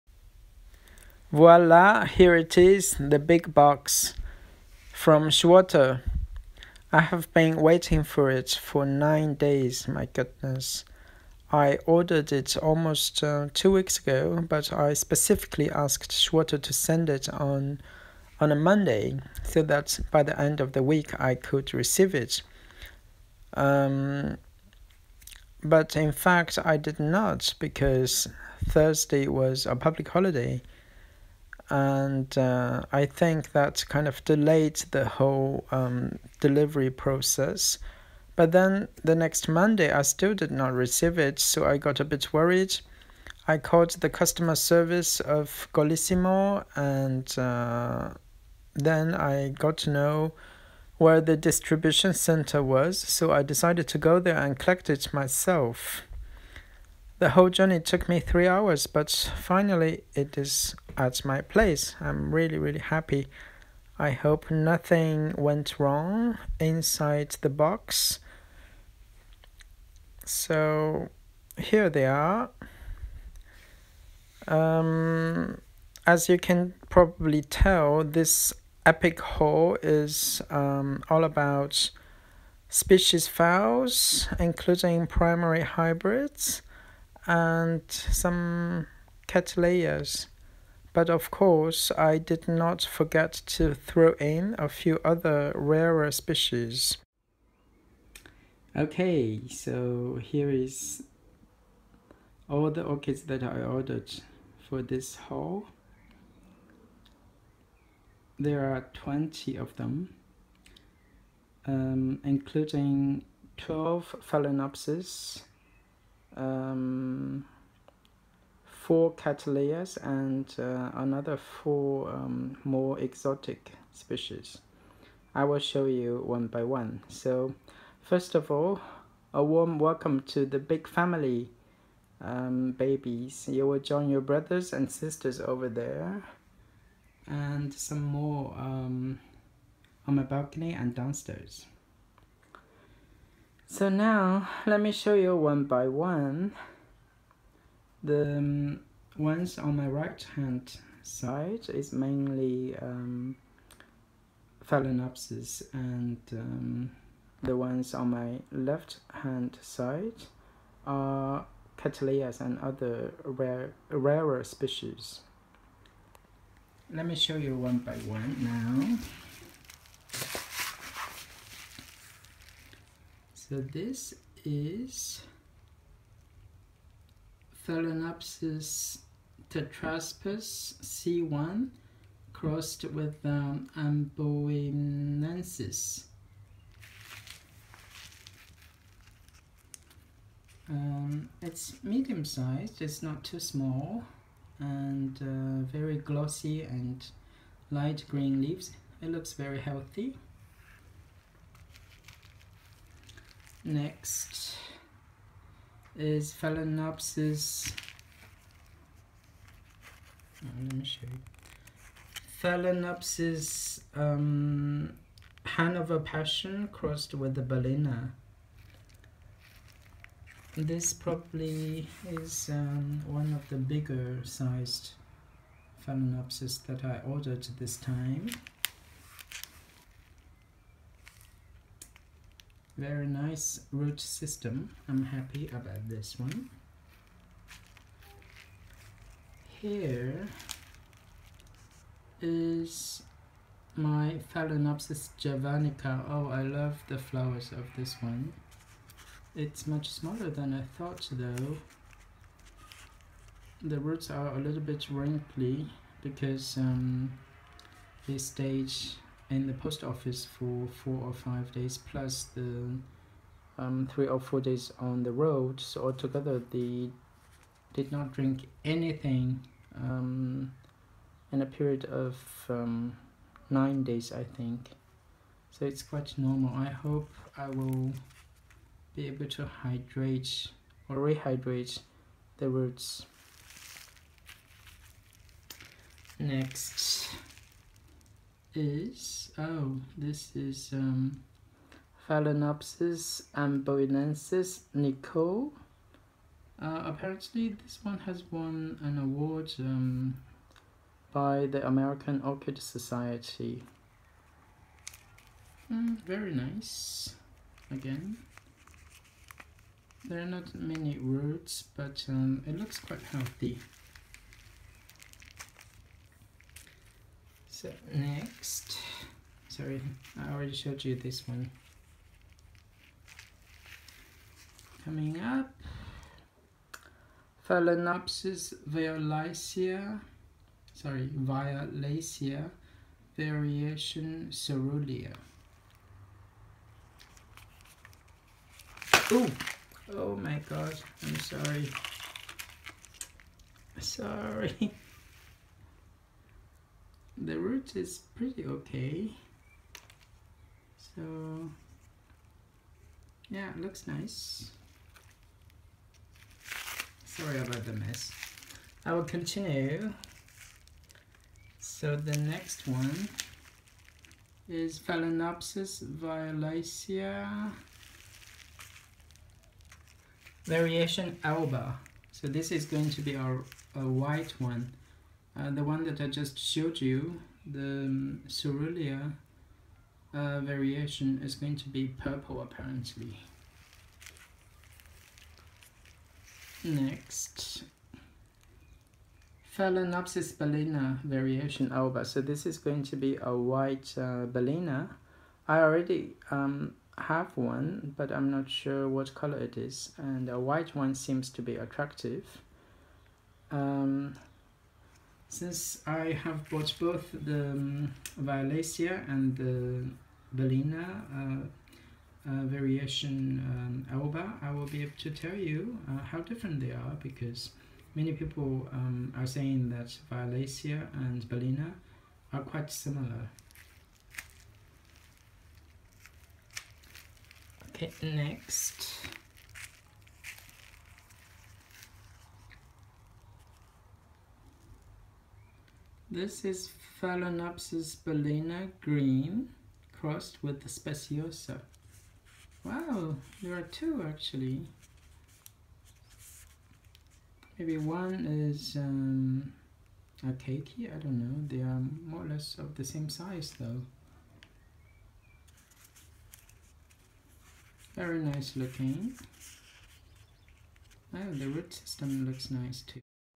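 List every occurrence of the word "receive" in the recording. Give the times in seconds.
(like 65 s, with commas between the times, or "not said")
21 s, 40 s.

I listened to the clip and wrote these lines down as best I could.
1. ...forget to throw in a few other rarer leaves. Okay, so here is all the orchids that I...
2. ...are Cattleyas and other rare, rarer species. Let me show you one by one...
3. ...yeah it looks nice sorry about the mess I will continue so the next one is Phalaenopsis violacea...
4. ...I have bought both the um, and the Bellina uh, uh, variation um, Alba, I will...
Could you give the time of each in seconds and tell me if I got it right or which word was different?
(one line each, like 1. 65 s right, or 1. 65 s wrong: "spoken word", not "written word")
1. 92 s wrong: "species", not "leaves"
2. 160 s right
3. 353 s right
4. 405 s right.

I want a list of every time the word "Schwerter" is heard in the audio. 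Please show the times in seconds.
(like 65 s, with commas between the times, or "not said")
5 s, 16 s.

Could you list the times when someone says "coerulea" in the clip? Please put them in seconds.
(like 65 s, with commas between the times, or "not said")
334 s, 378 s.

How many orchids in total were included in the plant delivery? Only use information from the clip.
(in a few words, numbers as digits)
20.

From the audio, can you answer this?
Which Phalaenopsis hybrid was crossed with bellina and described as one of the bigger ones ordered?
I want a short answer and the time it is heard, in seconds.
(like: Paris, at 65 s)
Hannover Passion, at 215 s.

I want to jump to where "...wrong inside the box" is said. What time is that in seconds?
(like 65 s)
65 s.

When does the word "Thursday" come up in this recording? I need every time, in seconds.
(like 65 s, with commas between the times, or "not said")
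28 s.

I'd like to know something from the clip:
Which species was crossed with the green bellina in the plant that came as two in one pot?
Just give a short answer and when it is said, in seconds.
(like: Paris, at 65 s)
speciosa, at 440 s.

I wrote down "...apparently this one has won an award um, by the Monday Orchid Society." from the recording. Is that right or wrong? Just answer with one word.
wrong.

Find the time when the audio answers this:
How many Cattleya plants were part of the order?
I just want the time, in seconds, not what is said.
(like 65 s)
118 s.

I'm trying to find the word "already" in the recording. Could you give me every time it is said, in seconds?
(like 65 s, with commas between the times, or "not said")
320 s, 395 s.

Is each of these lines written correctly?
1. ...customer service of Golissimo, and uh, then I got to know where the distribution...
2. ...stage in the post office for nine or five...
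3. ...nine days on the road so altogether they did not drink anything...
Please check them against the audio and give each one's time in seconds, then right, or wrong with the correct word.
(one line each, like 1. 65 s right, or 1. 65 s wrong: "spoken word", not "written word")
1. 44 s right
2. 258 s wrong: "four", not "nine"
3. 264 s wrong: "four", not "nine".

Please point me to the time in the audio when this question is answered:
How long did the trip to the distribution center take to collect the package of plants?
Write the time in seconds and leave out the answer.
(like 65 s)
58 s.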